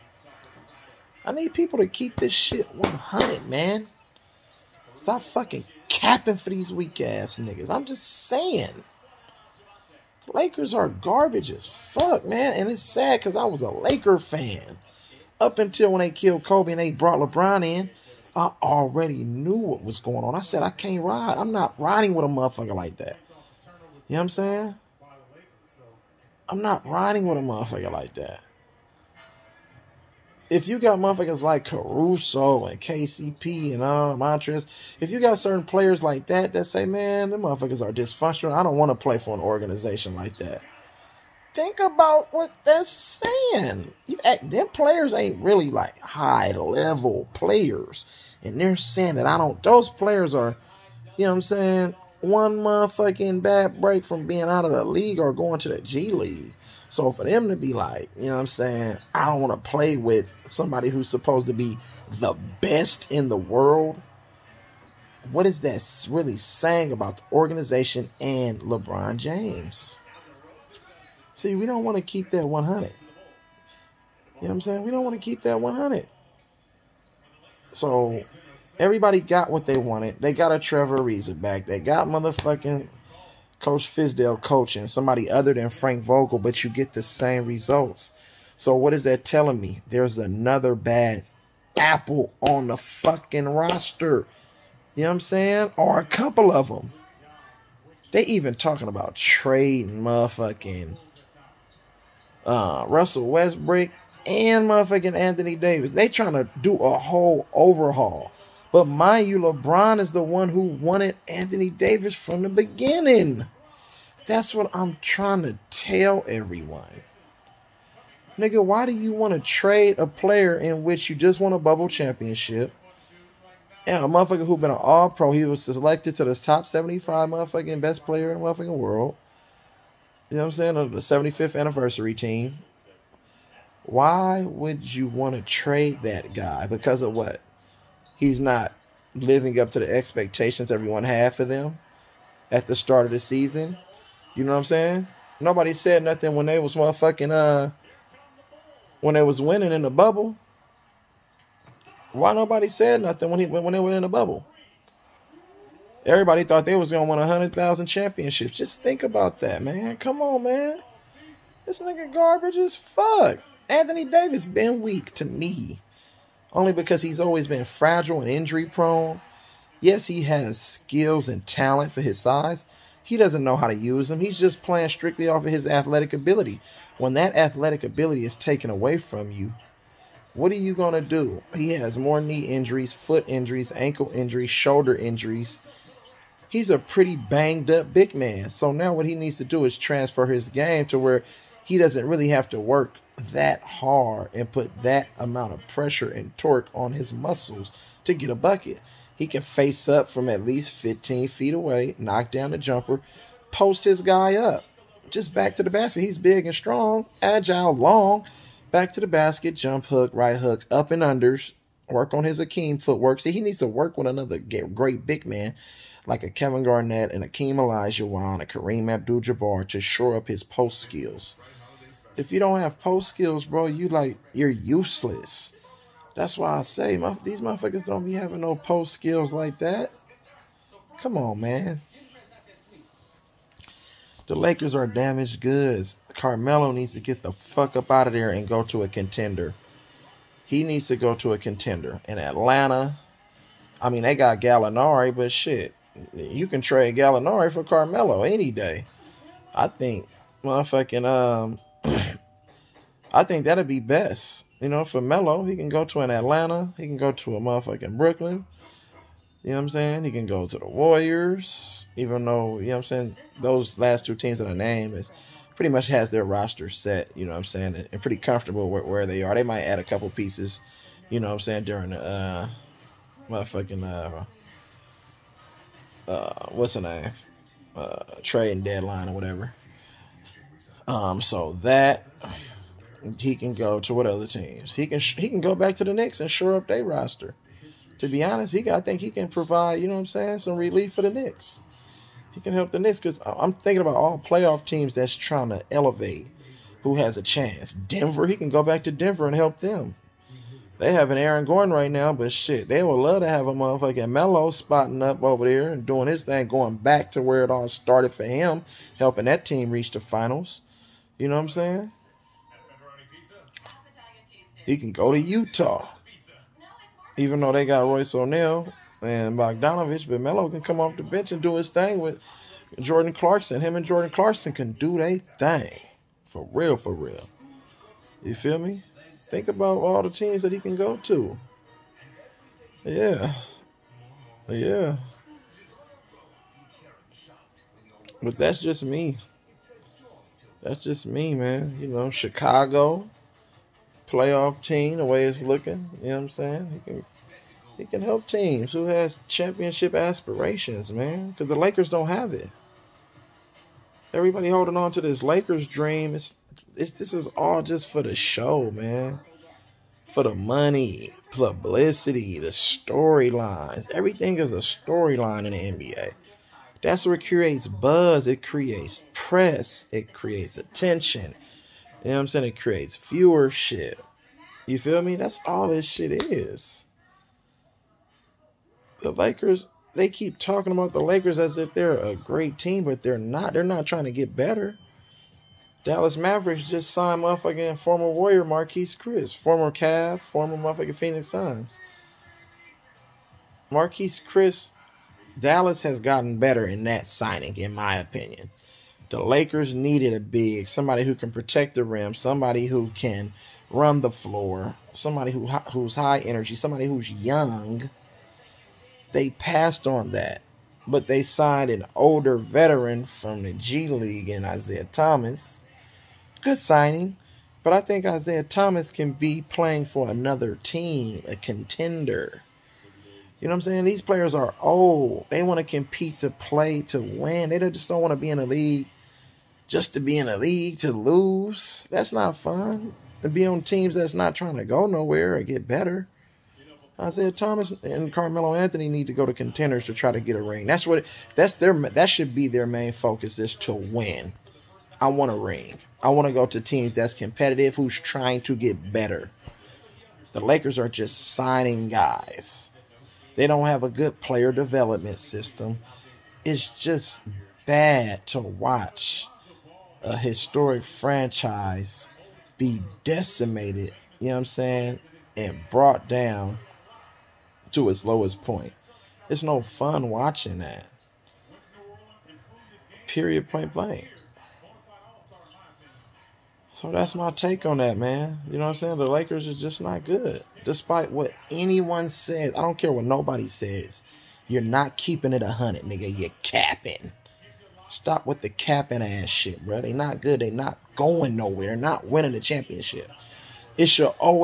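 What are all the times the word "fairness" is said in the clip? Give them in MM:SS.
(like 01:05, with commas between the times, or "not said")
not said.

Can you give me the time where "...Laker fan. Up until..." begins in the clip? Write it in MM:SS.
00:13.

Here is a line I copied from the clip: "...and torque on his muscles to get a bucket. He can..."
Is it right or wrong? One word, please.
right.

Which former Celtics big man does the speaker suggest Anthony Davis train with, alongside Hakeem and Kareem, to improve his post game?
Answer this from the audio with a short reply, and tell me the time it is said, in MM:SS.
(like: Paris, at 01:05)
Kevin Garnett, at 03:36.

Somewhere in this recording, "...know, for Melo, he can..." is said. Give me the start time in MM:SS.
04:14.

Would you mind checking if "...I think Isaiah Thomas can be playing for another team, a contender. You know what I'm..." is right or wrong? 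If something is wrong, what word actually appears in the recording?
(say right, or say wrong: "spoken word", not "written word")
right.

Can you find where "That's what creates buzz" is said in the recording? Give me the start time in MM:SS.
06:06.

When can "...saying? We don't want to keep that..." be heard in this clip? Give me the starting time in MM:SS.
01:14.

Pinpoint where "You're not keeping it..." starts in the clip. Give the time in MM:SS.
08:04.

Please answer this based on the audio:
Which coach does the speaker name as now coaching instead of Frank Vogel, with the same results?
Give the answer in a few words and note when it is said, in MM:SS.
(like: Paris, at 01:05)
Fizdale, at 01:23.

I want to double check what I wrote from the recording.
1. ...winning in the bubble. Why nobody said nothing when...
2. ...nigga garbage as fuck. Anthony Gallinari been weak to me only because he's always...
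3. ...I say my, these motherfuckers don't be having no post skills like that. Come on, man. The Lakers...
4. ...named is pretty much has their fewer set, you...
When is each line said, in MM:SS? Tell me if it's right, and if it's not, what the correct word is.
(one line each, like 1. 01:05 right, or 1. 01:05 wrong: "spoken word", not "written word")
1. 02:29 right
2. 02:41 wrong: "Davis", not "Gallinari"
3. 03:46 right
4. 04:24 wrong: "roster", not "fewer".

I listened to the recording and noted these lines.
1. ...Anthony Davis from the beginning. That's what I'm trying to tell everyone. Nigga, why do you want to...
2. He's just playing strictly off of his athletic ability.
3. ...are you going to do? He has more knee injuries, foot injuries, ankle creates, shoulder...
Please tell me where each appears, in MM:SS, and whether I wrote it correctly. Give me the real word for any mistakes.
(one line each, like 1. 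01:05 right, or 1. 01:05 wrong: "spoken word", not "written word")
1. 01:51 right
2. 02:54 right
3. 03:00 wrong: "injuries", not "creates".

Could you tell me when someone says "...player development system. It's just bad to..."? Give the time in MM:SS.
07:34.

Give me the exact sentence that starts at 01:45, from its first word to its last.
They trying to do a whole overhaul.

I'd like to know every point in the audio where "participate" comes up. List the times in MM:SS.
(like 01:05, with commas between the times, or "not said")
not said.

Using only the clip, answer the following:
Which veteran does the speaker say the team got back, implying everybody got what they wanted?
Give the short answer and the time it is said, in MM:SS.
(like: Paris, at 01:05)
Trevor Ariza, at 01:20.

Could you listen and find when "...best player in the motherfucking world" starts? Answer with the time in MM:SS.
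02:07.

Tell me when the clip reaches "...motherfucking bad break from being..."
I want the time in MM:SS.
00:52.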